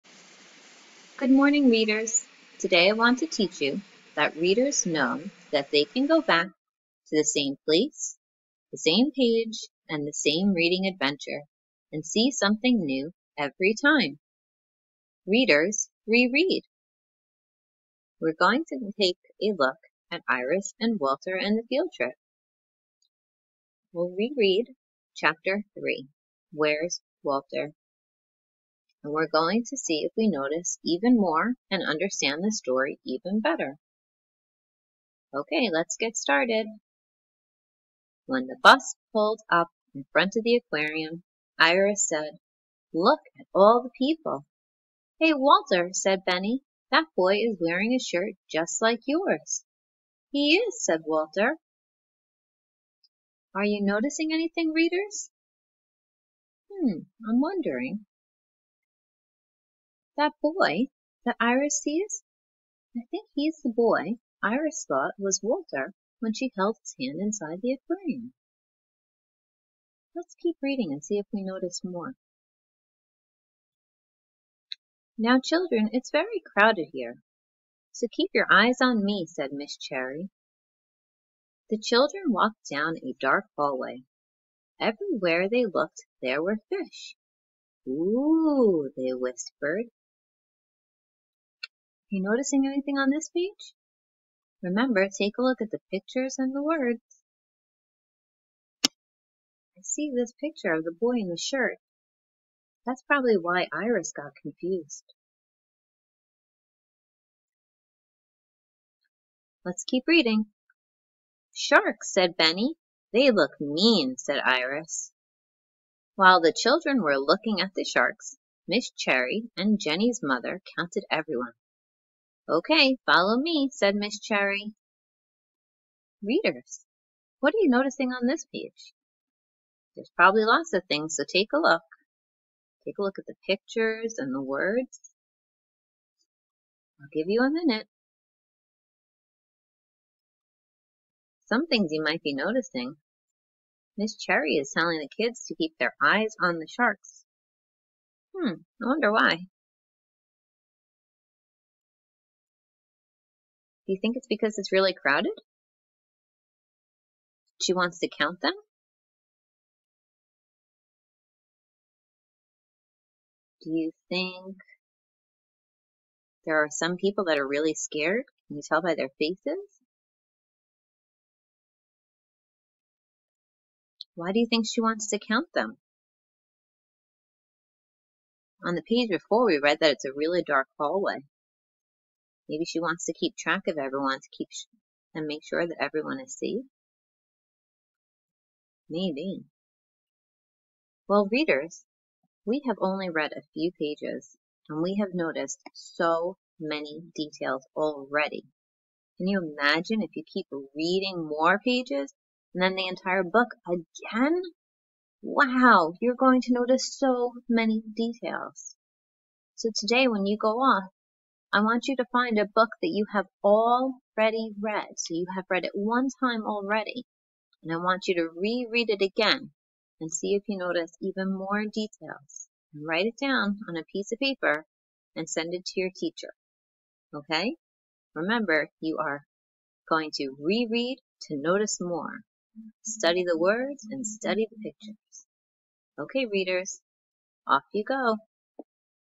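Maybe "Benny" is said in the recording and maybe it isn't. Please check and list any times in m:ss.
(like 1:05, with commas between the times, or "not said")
0:46, 1:52.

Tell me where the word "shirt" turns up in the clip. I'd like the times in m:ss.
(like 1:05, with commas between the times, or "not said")
0:47, 1:41.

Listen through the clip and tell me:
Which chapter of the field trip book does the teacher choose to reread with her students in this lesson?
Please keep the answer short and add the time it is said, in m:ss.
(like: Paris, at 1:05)
Chapter 3, at 0:25.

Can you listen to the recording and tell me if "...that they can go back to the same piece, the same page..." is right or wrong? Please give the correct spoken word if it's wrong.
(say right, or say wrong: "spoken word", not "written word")
wrong: "place", not "piece".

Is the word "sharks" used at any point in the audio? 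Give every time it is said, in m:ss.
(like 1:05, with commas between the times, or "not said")
1:51, 1:57, 2:26.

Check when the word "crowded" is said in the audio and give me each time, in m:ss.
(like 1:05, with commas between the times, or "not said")
1:16, 2:34.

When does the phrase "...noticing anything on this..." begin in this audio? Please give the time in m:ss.
1:32.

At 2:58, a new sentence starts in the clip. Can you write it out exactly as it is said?
On the page before, we read that it's a really dark hallway.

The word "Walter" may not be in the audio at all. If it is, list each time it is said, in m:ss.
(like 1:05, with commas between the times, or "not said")
0:20, 0:27, 0:45, 0:51, 1:05.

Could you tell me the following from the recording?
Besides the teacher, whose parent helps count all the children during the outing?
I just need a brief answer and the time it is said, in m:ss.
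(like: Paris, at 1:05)
Jenny's mother, at 1:59.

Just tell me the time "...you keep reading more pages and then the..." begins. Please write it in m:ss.
3:20.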